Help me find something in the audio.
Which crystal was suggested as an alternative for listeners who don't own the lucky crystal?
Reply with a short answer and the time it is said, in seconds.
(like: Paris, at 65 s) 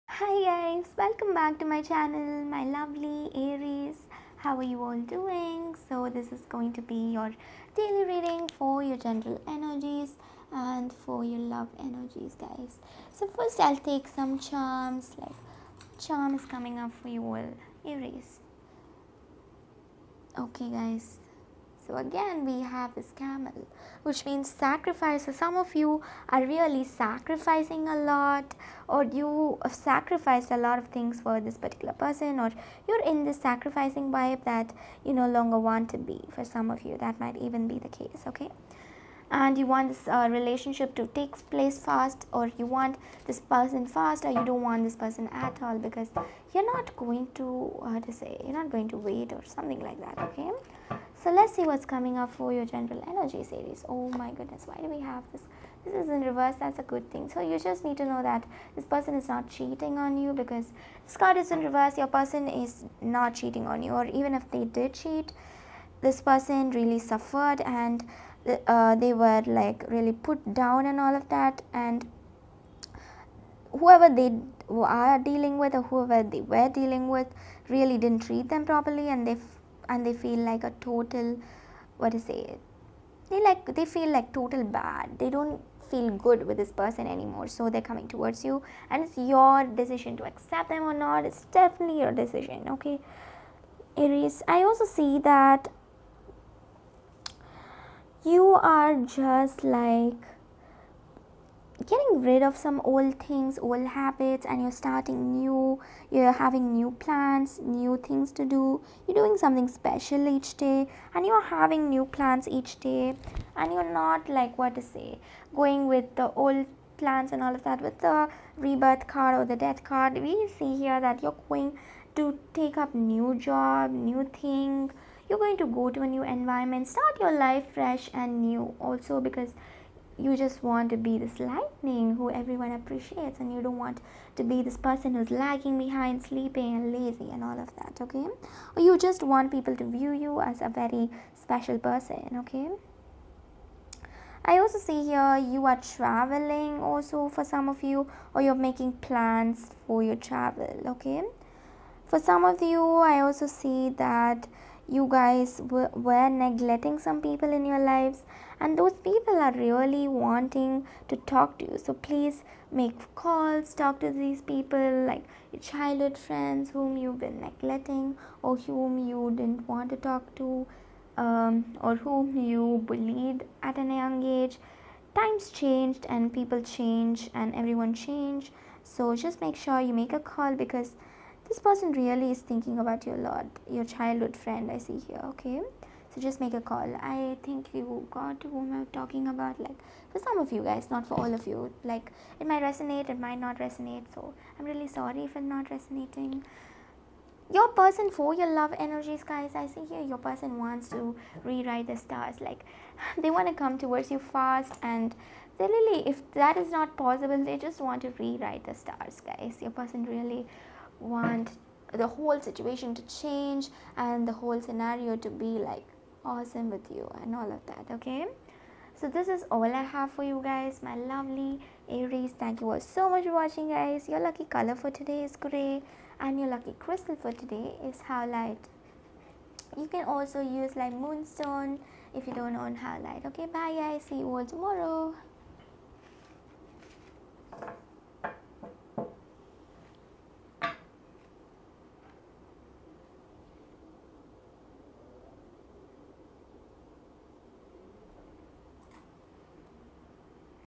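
Moonstone, at 230 s.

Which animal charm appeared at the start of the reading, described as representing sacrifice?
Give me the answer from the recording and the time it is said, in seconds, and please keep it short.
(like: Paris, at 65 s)
Camel, at 23 s.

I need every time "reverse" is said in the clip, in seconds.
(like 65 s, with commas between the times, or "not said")
56 s, 61 s.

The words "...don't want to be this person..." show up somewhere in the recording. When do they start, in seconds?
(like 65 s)
133 s.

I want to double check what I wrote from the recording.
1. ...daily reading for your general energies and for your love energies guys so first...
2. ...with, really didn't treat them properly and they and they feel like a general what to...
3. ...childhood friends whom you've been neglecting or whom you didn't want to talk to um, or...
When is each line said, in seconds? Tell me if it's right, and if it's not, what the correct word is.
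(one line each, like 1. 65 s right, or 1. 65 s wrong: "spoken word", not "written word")
1. 7 s right
2. 77 s wrong: "total", not "general"
3. 165 s right.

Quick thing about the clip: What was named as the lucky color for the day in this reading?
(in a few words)
Gray.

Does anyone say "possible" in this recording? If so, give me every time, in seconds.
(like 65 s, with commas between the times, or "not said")
206 s.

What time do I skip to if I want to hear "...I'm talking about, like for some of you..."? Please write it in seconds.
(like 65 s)
188 s.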